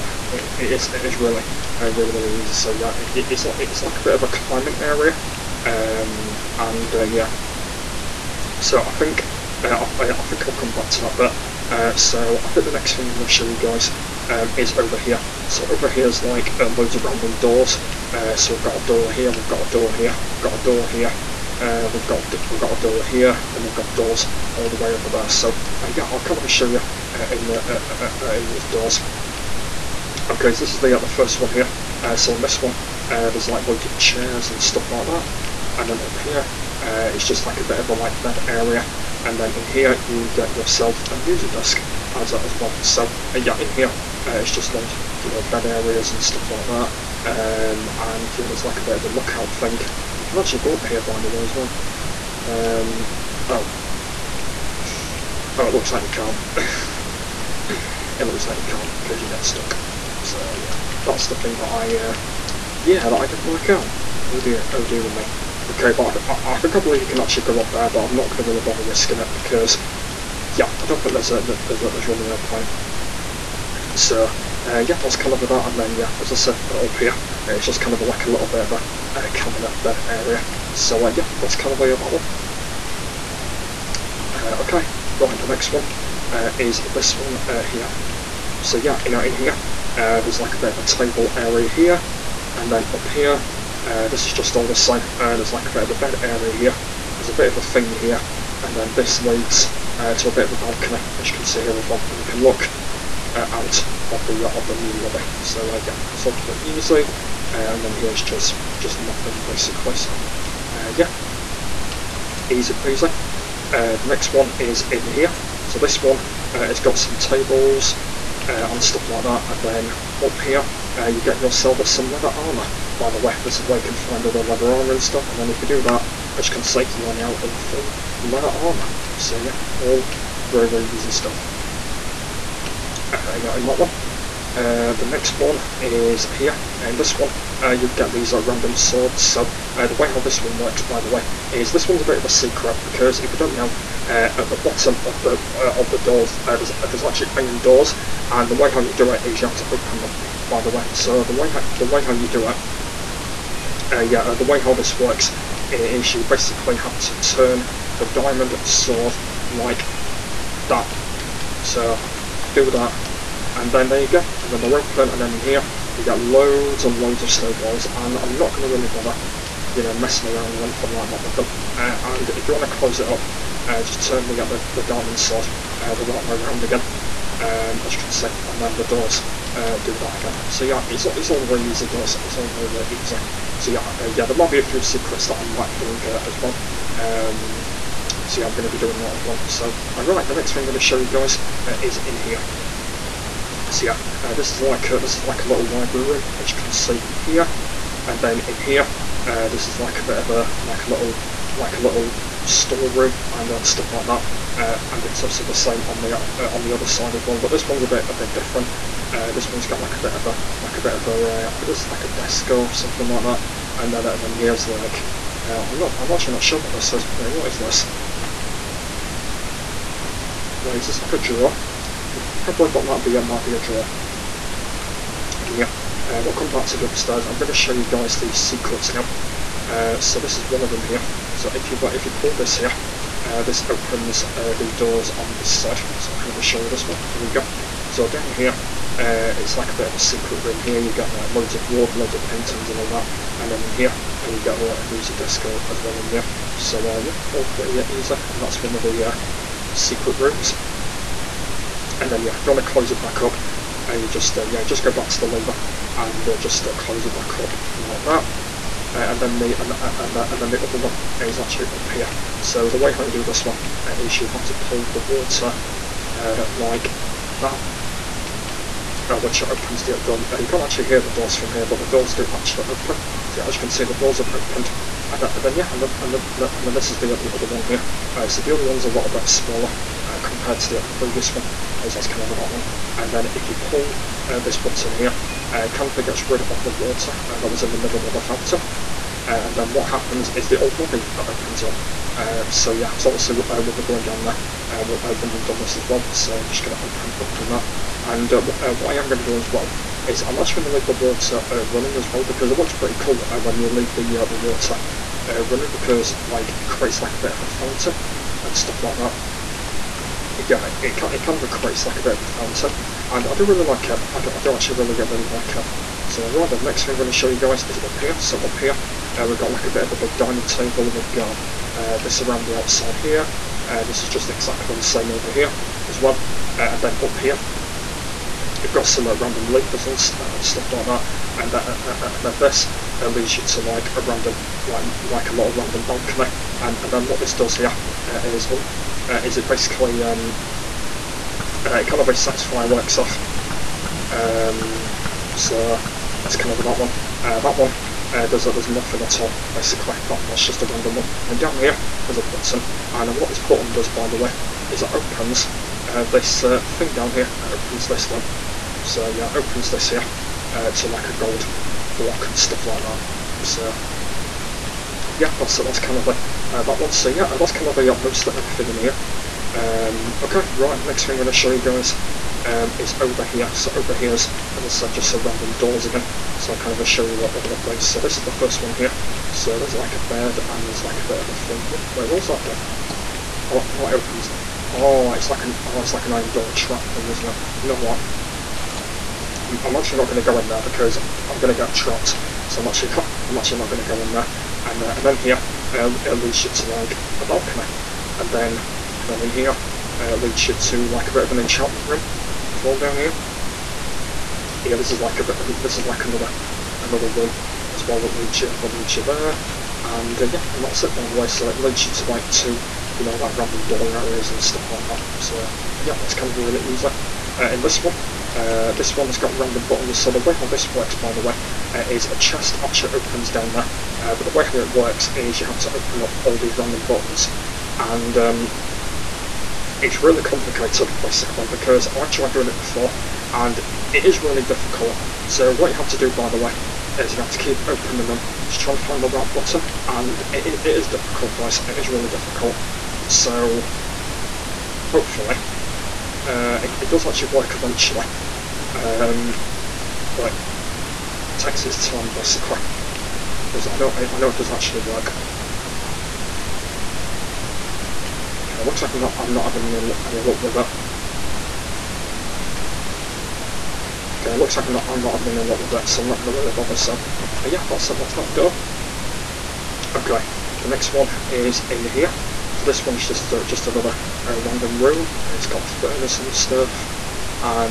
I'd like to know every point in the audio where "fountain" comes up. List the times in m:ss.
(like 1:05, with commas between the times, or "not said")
4:48, 5:07, 5:12.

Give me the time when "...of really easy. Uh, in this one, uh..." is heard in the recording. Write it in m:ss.
6:56.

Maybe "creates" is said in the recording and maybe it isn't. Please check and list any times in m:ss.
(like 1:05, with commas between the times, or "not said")
5:06, 5:11.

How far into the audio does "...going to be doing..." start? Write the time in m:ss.
3:08.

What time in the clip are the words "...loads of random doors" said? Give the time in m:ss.
0:16.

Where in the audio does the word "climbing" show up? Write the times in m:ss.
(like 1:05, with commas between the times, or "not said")
0:04.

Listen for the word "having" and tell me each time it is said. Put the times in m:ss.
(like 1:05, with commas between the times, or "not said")
7:39, 7:45.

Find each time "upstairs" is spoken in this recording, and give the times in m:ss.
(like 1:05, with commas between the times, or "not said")
3:46.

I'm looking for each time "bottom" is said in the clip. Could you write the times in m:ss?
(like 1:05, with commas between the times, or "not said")
2:24.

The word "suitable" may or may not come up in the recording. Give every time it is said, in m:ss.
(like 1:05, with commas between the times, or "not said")
not said.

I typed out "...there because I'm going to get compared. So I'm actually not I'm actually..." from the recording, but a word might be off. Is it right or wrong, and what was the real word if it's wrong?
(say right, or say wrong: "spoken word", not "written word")
wrong: "trapped", not "compared".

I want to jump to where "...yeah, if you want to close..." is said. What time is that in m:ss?
4:12.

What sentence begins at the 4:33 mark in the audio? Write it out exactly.
So yeah, as you can see, the doors have opened.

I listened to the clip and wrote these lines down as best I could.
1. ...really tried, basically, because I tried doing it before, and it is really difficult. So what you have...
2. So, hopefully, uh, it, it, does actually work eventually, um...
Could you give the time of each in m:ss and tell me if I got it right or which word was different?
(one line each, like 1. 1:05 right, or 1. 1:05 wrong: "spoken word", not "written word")
1. 7:10 wrong: "complicated", not "tried"
2. 7:23 right.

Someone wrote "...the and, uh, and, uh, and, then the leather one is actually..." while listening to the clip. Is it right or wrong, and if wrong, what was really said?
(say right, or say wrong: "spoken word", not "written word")
wrong: "upper", not "leather".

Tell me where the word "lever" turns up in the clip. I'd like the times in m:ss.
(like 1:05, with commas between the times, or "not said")
4:15, 5:29.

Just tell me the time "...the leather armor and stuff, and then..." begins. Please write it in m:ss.
2:04.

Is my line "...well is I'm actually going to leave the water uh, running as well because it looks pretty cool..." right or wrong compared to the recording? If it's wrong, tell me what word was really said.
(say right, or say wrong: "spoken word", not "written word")
right.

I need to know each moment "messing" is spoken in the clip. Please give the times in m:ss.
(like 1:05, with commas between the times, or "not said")
2:49.